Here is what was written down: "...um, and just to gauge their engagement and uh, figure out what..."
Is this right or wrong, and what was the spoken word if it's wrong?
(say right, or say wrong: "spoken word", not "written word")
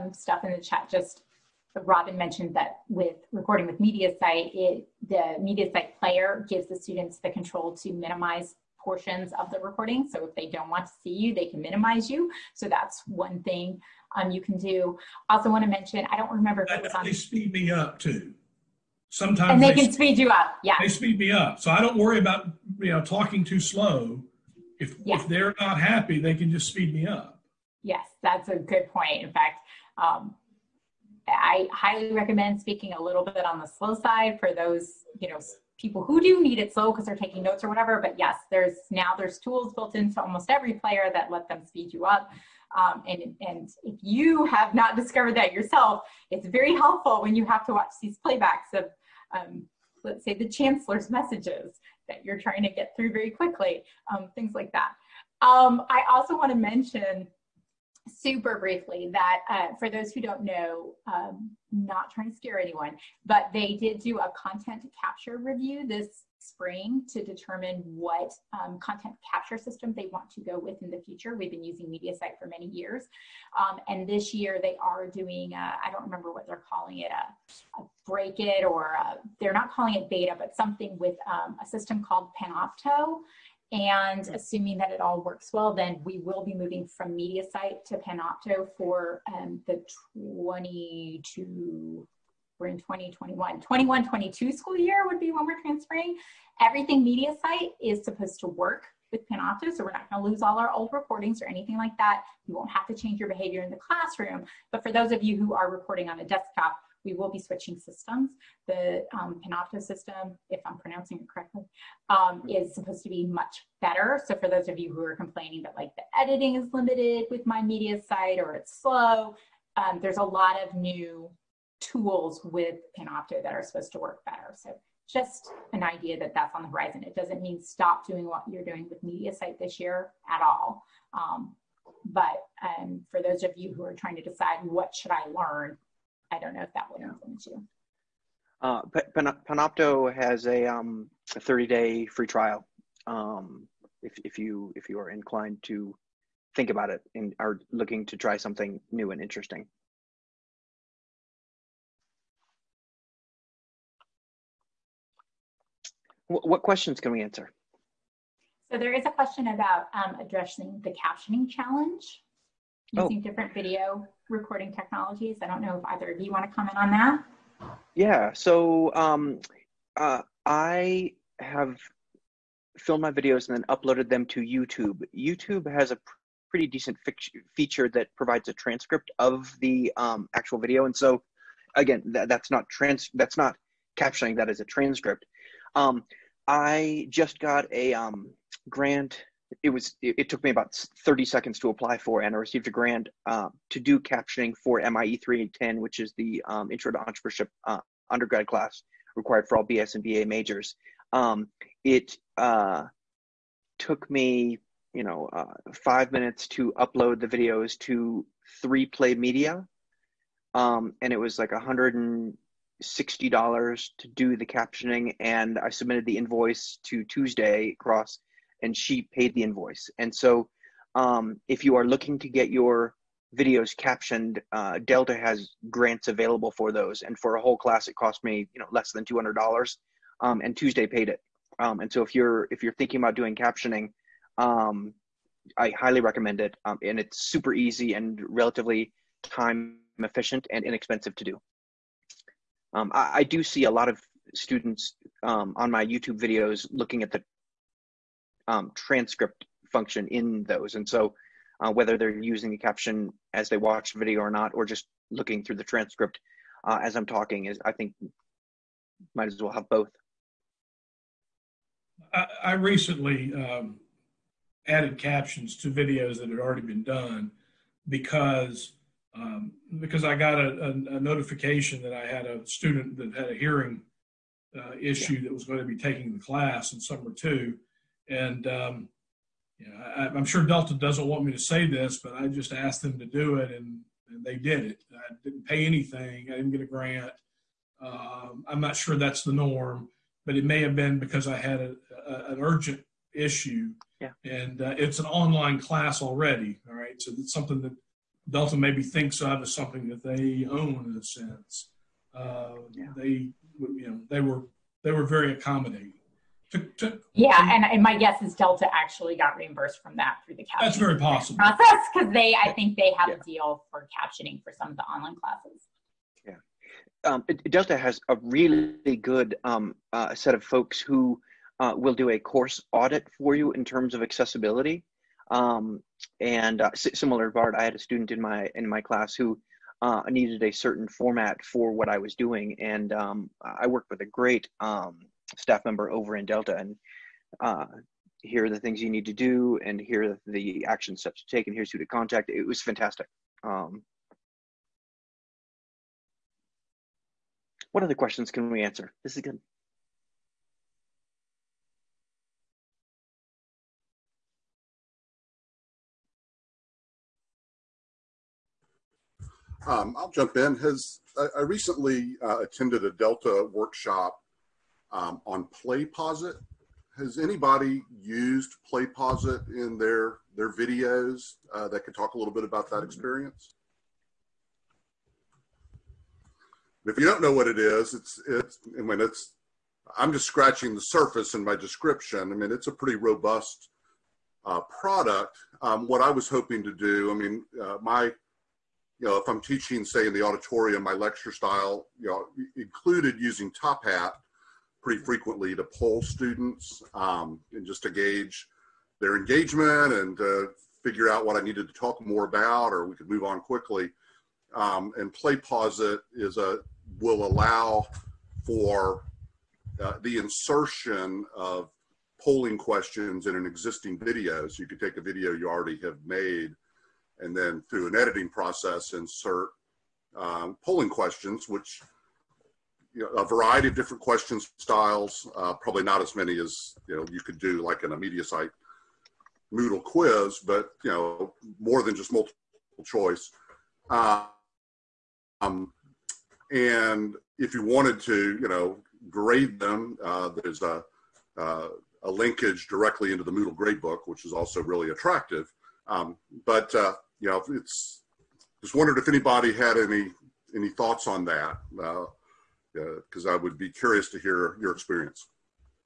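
right.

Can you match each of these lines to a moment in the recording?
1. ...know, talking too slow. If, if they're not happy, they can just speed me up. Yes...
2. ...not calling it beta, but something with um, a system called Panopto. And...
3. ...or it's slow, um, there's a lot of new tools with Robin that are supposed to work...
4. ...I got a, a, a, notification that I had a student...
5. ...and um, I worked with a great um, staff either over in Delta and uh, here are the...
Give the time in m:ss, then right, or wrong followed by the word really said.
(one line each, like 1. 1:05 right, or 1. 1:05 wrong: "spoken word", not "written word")
1. 0:22 right
2. 1:19 right
3. 1:58 wrong: "Panopto", not "Robin"
4. 4:30 right
5. 5:32 wrong: "member", not "either".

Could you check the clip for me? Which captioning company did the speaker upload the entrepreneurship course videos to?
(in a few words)
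3Play Media.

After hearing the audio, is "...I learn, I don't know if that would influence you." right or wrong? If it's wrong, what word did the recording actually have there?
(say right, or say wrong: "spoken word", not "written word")
right.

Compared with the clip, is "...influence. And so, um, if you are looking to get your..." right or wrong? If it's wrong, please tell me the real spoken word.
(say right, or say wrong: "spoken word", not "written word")
wrong: "invoice", not "influence".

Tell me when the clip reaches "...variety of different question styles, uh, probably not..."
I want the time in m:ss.
7:03.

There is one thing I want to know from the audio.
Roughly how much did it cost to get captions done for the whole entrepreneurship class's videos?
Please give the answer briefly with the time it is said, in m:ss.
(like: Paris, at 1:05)
$160, at 3:31.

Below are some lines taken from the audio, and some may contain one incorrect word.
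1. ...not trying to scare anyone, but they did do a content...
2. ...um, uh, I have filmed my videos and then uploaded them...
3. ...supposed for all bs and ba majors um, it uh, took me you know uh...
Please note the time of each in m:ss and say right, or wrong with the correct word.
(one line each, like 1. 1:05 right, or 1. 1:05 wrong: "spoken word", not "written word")
1. 1:01 right
2. 2:48 right
3. 3:19 wrong: "required", not "supposed".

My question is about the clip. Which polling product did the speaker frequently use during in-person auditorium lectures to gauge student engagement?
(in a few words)
Top Hat.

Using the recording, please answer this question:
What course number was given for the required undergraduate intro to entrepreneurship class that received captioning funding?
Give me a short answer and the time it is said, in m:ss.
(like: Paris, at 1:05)
MIE 310, at 3:14.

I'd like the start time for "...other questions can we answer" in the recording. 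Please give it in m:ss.
5:47.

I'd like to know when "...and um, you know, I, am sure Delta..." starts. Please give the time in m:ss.
4:38.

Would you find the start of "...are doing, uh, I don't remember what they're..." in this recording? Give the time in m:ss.
1:14.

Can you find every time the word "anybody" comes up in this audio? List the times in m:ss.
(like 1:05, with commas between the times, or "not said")
6:07, 7:29.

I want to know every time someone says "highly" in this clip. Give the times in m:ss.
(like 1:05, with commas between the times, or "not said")
0:31, 3:55.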